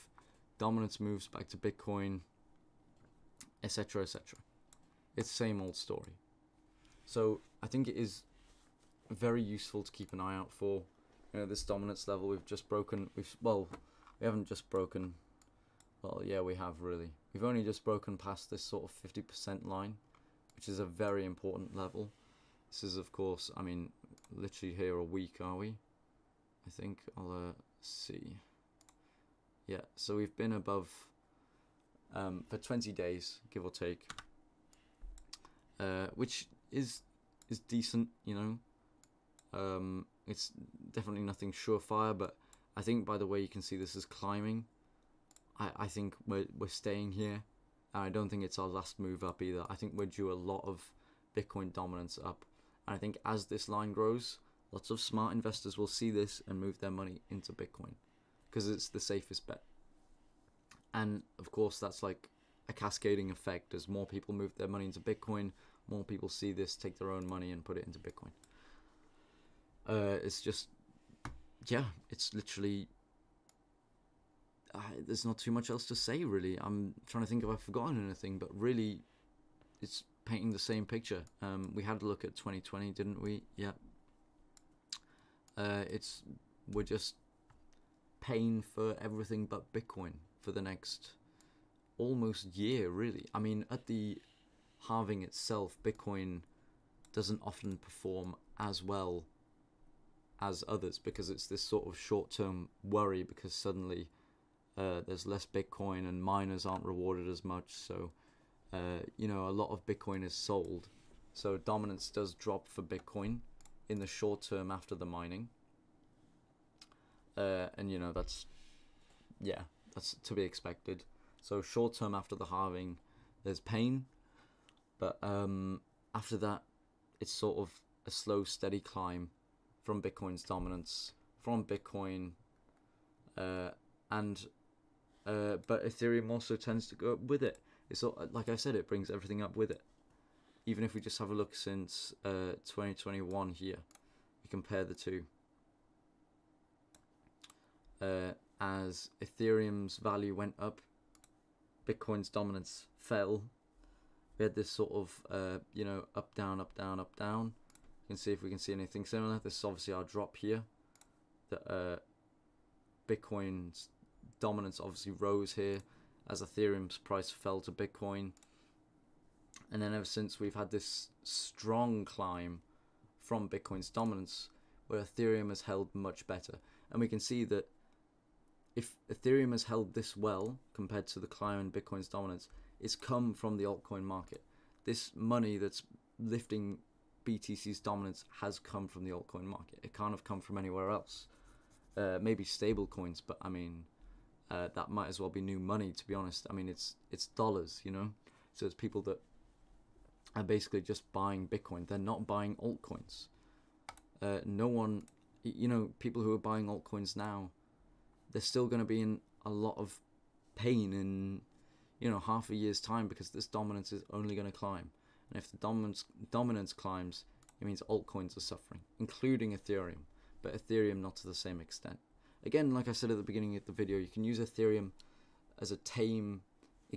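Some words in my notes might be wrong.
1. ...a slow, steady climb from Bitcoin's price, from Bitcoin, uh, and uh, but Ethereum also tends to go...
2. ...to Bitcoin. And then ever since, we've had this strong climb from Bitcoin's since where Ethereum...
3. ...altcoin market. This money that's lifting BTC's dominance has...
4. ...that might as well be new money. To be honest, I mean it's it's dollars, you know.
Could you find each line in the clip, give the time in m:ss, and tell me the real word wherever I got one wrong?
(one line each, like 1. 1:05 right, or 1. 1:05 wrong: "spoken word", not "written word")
1. 2:08 wrong: "dominance", not "price"
2. 2:47 wrong: "dominance", not "since"
3. 3:03 right
4. 3:14 right.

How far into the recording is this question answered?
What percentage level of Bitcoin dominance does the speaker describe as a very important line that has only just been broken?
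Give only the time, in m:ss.
0:19.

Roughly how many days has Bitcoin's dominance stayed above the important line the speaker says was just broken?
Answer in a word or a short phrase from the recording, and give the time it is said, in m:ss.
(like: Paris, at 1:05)
20 days, at 0:32.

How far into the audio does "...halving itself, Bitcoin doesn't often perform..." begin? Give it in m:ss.
1:34.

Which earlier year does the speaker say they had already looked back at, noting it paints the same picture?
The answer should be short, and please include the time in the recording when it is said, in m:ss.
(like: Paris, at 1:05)
2020, at 1:22.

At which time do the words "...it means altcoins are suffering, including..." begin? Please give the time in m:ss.
3:37.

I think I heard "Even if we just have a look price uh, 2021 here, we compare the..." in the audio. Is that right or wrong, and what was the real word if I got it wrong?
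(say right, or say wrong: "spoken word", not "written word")
wrong: "since", not "price".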